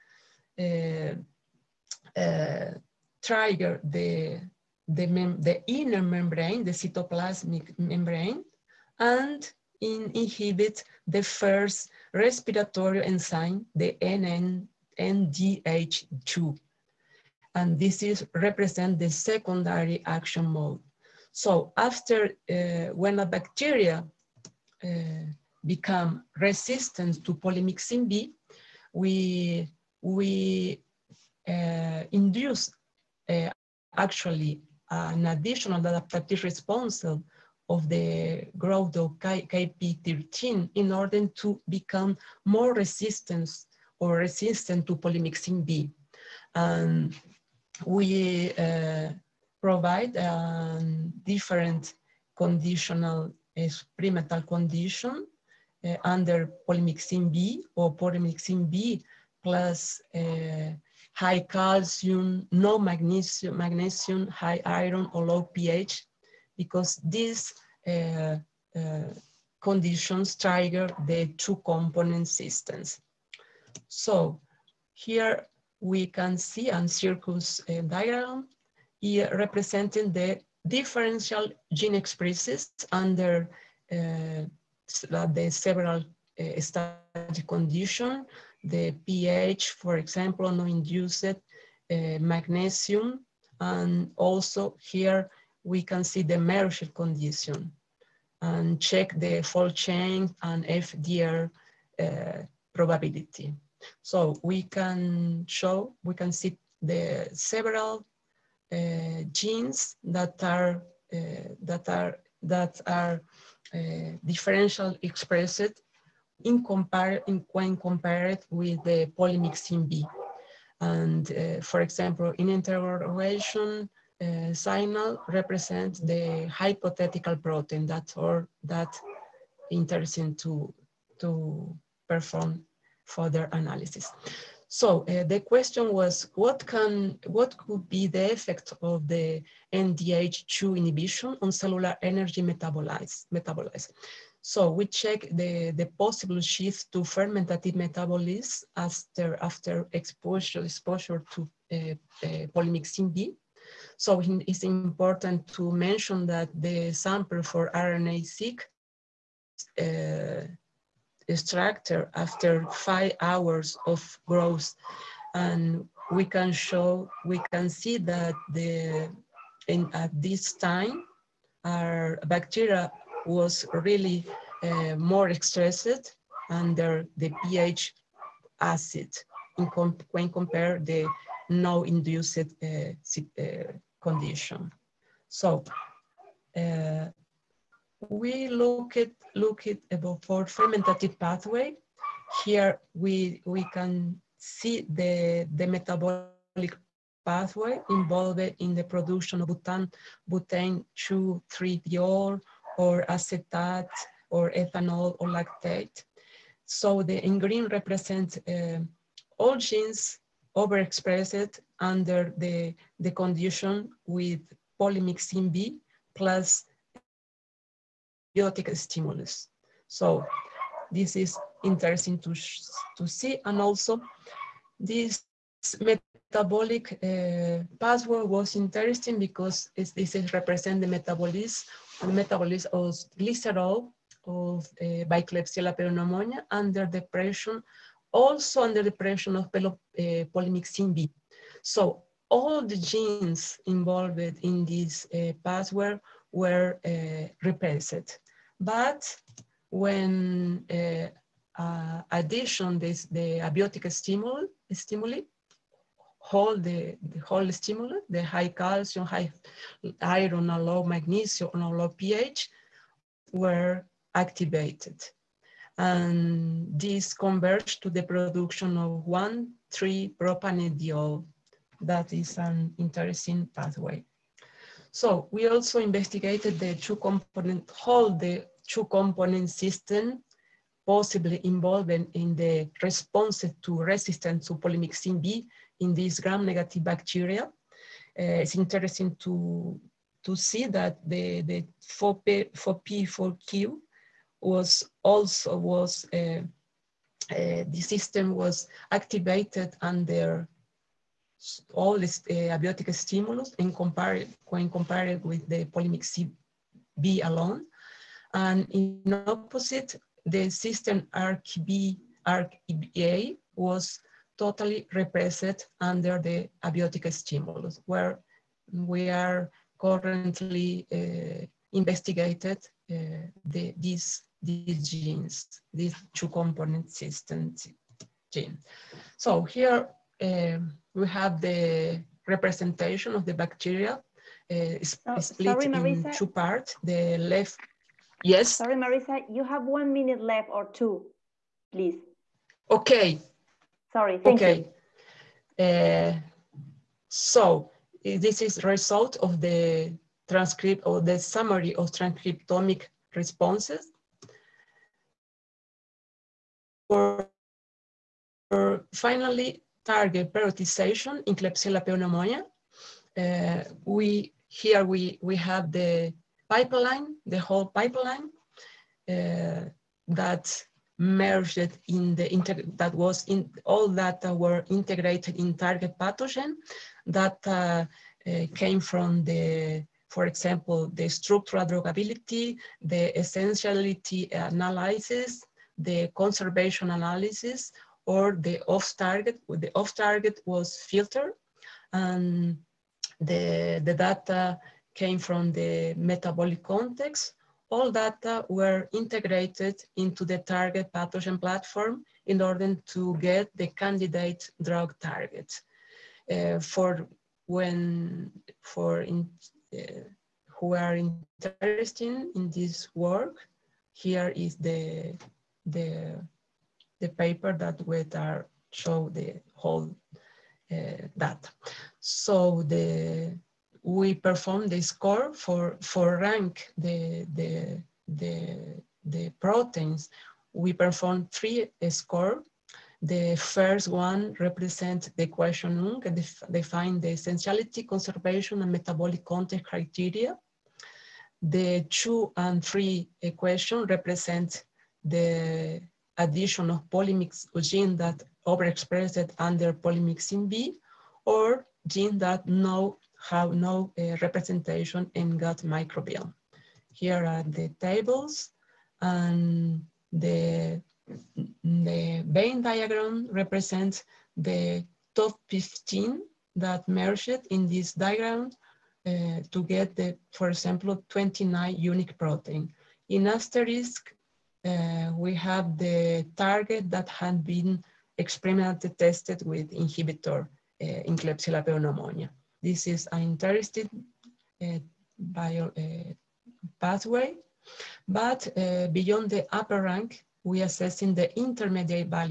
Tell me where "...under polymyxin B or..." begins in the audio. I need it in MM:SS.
00:56.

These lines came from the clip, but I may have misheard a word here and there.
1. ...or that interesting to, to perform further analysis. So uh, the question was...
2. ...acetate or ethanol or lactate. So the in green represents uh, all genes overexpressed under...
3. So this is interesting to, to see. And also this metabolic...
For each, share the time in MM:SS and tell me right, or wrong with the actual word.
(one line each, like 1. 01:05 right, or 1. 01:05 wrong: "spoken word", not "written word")
1. 02:08 right
2. 03:23 right
3. 03:39 right.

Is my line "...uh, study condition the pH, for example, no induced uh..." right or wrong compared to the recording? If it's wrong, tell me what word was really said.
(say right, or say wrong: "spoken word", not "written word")
right.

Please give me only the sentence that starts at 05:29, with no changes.
So here um, we have the representation of the bacteria uh, oh, split sorry, in two parts, the left, yes.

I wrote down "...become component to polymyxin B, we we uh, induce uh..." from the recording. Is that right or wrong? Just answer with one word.
wrong.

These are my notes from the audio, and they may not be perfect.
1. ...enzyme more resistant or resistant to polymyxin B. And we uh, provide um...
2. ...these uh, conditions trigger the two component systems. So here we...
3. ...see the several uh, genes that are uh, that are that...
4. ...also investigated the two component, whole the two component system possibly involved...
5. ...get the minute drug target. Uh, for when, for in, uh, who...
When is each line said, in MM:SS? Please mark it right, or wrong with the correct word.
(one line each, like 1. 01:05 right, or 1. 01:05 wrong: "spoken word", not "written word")
1. 00:41 wrong: "become", not "enzyme"
2. 01:07 right
3. 01:46 right
4. 04:35 right
5. 06:43 wrong: "candidate", not "minute".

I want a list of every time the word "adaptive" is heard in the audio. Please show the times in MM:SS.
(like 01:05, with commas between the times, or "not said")
00:35.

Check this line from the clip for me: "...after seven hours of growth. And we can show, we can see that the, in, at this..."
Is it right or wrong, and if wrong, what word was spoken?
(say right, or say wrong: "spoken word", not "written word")
wrong: "five", not "seven".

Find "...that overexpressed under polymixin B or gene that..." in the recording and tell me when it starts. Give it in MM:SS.
07:27.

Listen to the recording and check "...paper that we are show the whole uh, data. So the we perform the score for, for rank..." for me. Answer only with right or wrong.
right.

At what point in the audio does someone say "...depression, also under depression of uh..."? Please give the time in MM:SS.
03:56.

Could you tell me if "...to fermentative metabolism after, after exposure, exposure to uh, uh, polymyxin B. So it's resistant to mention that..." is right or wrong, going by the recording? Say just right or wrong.
wrong.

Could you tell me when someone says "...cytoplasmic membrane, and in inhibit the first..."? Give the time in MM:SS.
00:06.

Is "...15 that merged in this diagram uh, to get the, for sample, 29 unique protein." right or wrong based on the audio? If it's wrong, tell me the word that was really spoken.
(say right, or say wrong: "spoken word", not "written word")
wrong: "example", not "sample".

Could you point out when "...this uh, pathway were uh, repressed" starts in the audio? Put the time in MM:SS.
04:04.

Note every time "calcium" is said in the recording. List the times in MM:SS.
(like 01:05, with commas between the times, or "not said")
01:01, 04:18.